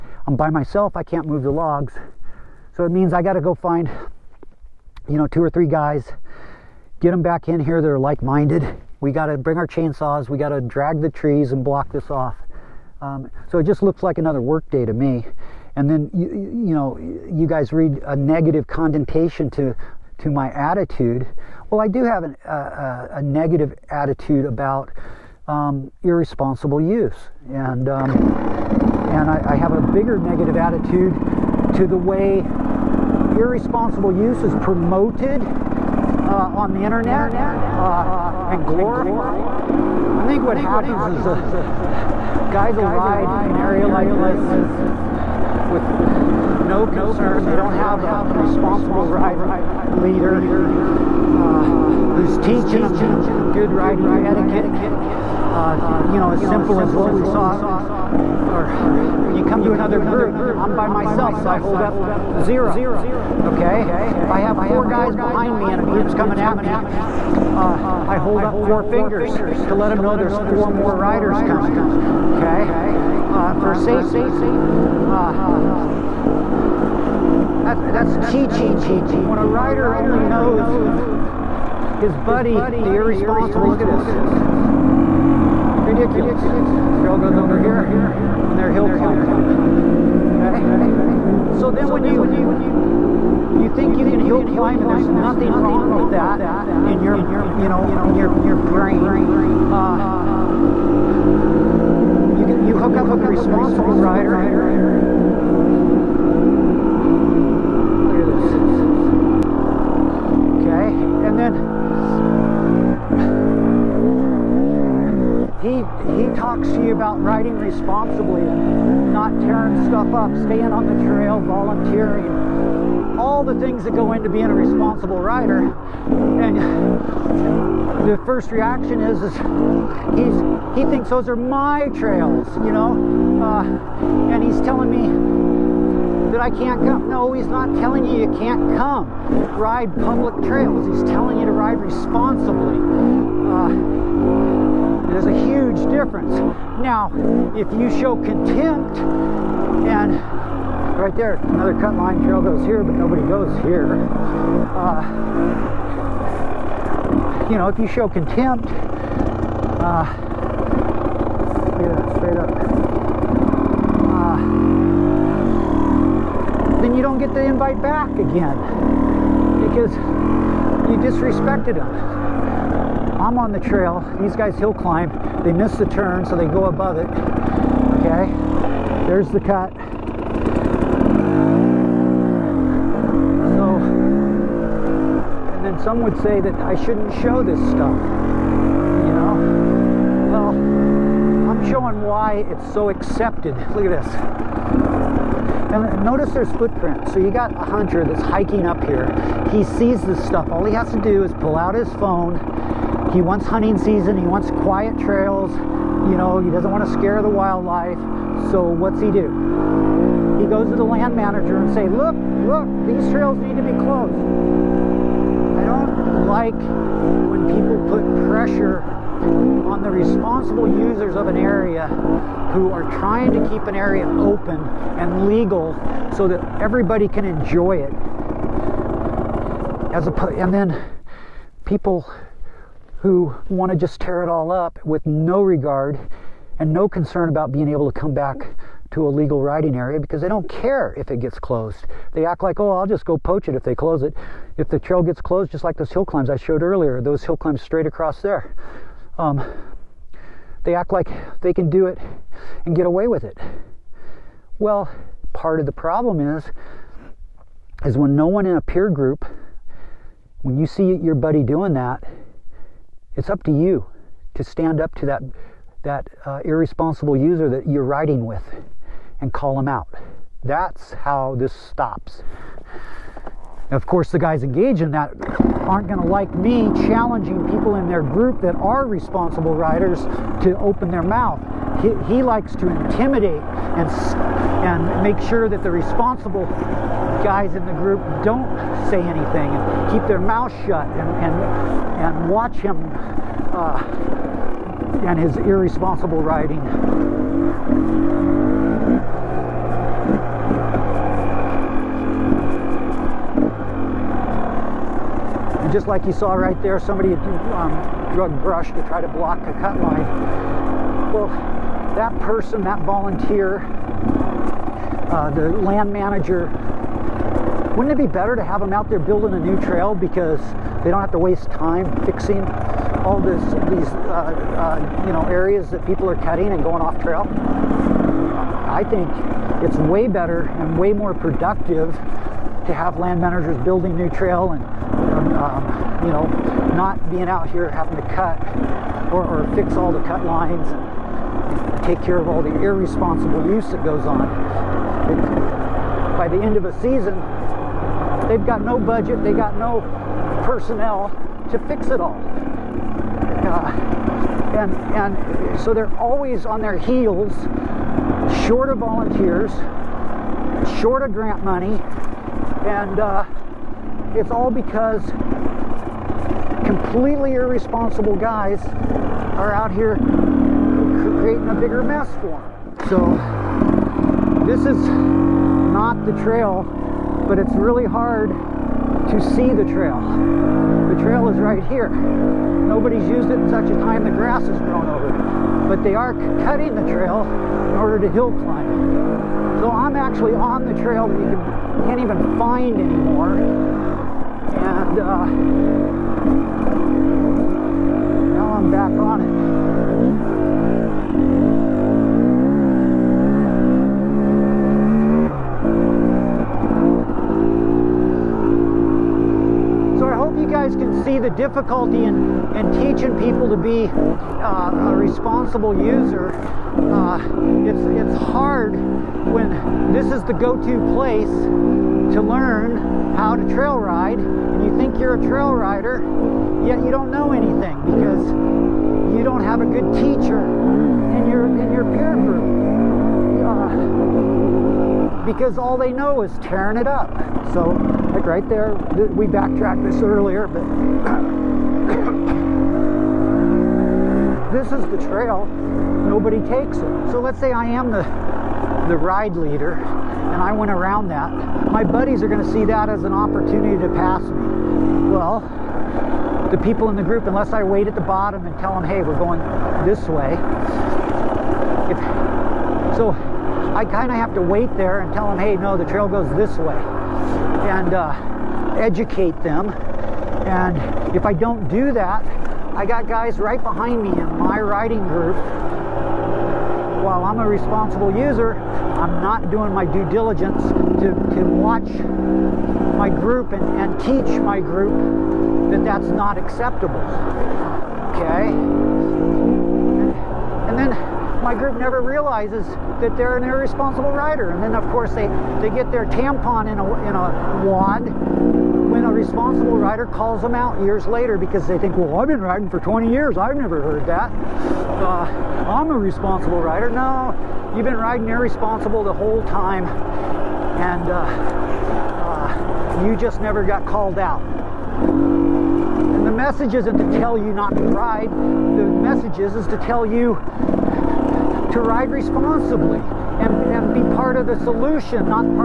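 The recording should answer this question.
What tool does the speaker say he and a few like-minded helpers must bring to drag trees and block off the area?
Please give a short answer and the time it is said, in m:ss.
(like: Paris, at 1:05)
chainsaws, at 0:09.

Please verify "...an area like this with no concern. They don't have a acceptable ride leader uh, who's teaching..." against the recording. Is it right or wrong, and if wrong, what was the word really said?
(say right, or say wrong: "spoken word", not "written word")
wrong: "responsible", not "acceptable".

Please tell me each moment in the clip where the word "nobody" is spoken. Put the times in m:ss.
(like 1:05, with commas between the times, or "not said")
2:32, 6:21, 7:26.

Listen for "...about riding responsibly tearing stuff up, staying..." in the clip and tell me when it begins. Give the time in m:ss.
1:56.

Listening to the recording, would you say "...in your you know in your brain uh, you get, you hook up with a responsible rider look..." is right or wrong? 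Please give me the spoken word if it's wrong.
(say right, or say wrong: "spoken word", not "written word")
right.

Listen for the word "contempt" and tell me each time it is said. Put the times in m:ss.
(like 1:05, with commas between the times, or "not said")
2:28, 2:38.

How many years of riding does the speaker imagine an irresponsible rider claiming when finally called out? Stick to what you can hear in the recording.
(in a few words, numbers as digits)
20.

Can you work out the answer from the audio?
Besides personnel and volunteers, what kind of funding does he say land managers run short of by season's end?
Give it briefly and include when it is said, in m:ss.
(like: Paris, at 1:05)
grant money, at 6:01.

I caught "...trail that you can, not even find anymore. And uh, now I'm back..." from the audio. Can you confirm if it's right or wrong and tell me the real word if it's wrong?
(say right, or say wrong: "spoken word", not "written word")
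right.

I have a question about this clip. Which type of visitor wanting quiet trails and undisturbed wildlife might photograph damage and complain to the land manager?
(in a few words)
a hunter.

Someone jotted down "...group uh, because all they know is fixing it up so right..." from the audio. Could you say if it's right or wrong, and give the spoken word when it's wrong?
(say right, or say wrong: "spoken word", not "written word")
wrong: "tearing", not "fixing".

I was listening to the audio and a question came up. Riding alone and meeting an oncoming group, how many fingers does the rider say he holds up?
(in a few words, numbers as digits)
0.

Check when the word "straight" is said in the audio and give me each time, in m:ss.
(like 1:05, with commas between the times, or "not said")
2:42, 4:07.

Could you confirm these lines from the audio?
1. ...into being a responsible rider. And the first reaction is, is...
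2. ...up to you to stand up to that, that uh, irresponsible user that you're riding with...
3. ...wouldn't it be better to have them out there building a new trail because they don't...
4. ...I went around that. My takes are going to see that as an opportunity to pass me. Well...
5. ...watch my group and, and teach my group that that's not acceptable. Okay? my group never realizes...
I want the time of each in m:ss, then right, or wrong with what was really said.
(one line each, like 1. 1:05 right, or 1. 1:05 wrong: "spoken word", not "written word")
1. 2:04 right
2. 4:23 right
3. 5:17 right
4. 7:30 wrong: "buddies", not "takes"
5. 8:01 right.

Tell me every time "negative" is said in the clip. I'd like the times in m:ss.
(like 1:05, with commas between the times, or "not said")
0:18, 0:23, 0:30.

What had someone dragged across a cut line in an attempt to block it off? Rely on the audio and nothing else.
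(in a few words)
brush.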